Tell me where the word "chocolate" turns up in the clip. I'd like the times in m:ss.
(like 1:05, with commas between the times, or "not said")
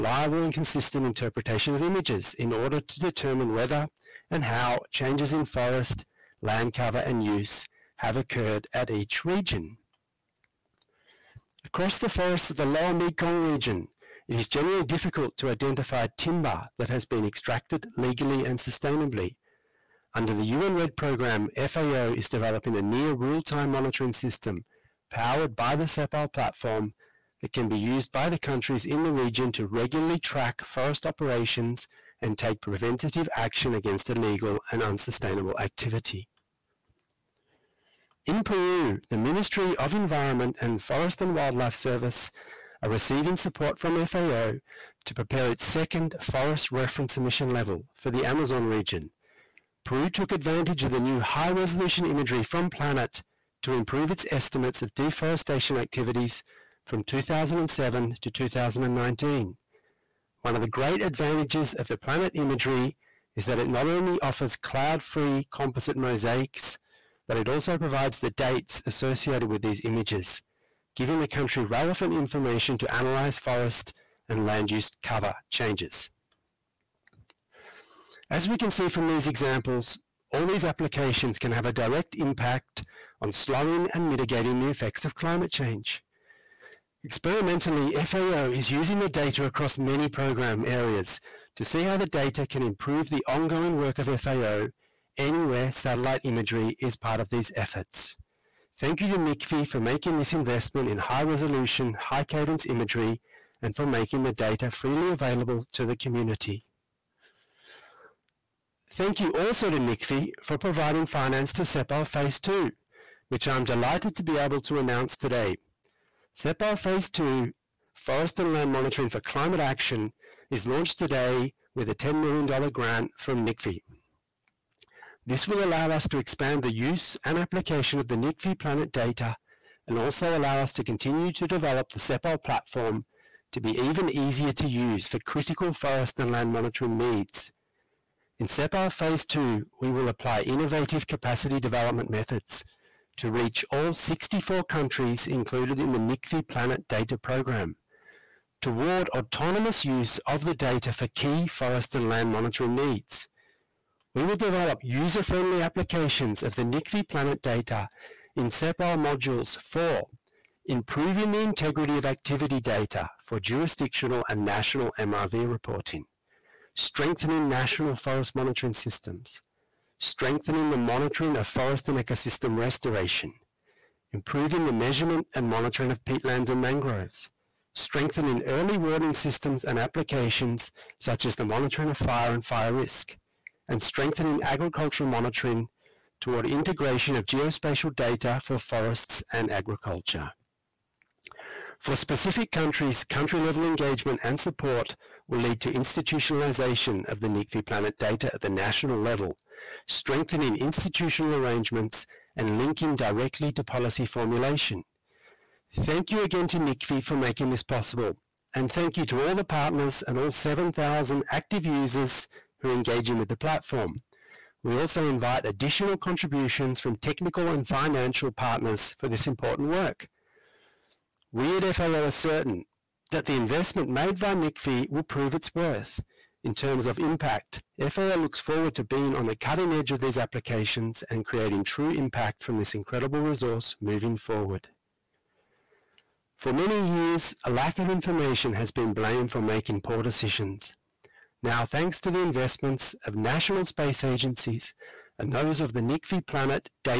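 not said.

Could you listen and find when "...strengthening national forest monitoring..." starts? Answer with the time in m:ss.
2:46.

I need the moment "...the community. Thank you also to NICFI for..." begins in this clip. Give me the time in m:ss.
1:45.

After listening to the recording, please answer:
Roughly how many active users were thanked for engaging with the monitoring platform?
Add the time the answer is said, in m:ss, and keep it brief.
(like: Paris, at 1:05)
7,000, at 3:30.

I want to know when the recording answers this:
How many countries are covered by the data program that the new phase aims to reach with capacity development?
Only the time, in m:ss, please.
2:23.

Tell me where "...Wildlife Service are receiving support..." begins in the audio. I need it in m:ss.
0:41.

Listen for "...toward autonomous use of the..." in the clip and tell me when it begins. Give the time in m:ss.
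2:28.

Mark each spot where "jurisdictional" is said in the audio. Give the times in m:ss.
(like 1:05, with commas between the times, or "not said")
2:43.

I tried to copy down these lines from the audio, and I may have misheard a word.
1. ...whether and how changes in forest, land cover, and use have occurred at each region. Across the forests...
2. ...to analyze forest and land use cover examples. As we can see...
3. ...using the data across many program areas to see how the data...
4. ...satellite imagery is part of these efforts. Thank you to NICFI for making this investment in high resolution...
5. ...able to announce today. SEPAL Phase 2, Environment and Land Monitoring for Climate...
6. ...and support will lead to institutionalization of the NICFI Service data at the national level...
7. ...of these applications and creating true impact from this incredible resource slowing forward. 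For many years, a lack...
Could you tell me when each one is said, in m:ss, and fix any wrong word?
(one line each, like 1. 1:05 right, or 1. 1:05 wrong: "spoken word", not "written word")
1. 0:03 right
2. 1:12 wrong: "changes", not "examples"
3. 1:28 right
4. 1:35 right
5. 1:54 wrong: "Forest", not "Environment"
6. 3:14 wrong: "Planet", not "Service"
7. 3:49 wrong: "moving", not "slowing".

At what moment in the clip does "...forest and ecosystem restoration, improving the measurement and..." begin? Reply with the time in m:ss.
2:51.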